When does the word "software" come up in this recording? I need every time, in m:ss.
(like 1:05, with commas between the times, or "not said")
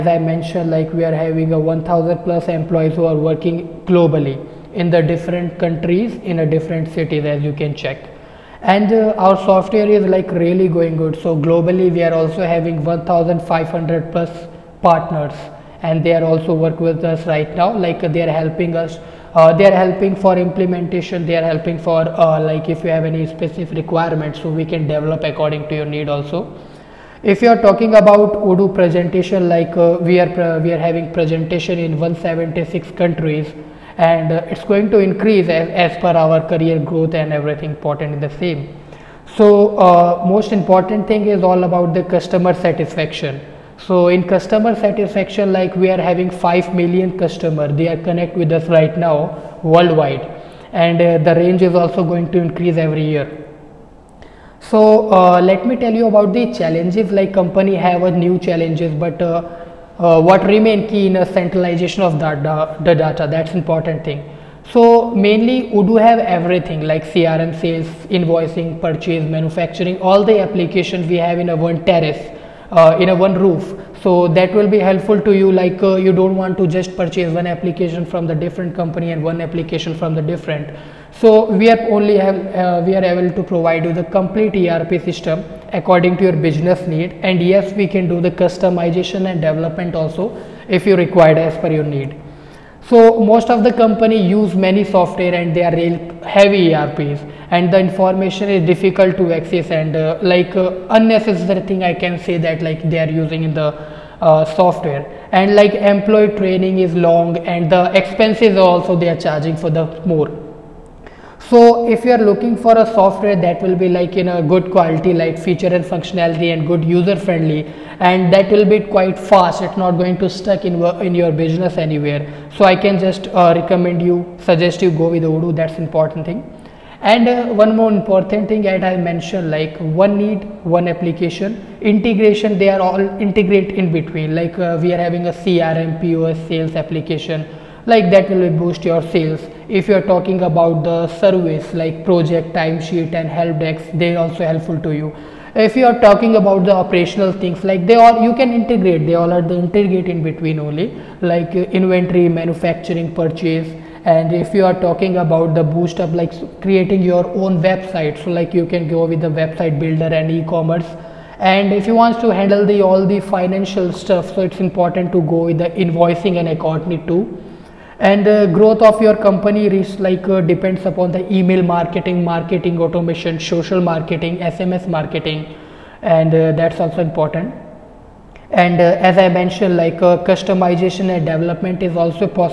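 0:09, 1:34, 1:44, 1:52.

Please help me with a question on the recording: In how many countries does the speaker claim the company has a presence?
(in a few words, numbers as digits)
176.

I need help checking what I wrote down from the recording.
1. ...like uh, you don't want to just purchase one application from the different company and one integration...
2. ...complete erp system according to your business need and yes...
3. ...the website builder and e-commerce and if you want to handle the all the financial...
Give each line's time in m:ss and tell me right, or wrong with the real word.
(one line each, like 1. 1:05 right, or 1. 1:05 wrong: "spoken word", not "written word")
1. 1:15 wrong: "application", not "integration"
2. 1:24 right
3. 2:39 right.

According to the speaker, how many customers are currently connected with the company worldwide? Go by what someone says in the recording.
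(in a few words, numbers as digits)
5 million.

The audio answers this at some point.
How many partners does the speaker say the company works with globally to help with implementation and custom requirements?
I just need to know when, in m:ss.
0:12.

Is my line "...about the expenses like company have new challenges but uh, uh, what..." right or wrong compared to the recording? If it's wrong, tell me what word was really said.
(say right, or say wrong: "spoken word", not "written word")
wrong: "challenges", not "expenses".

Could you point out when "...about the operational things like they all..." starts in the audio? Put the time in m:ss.
2:26.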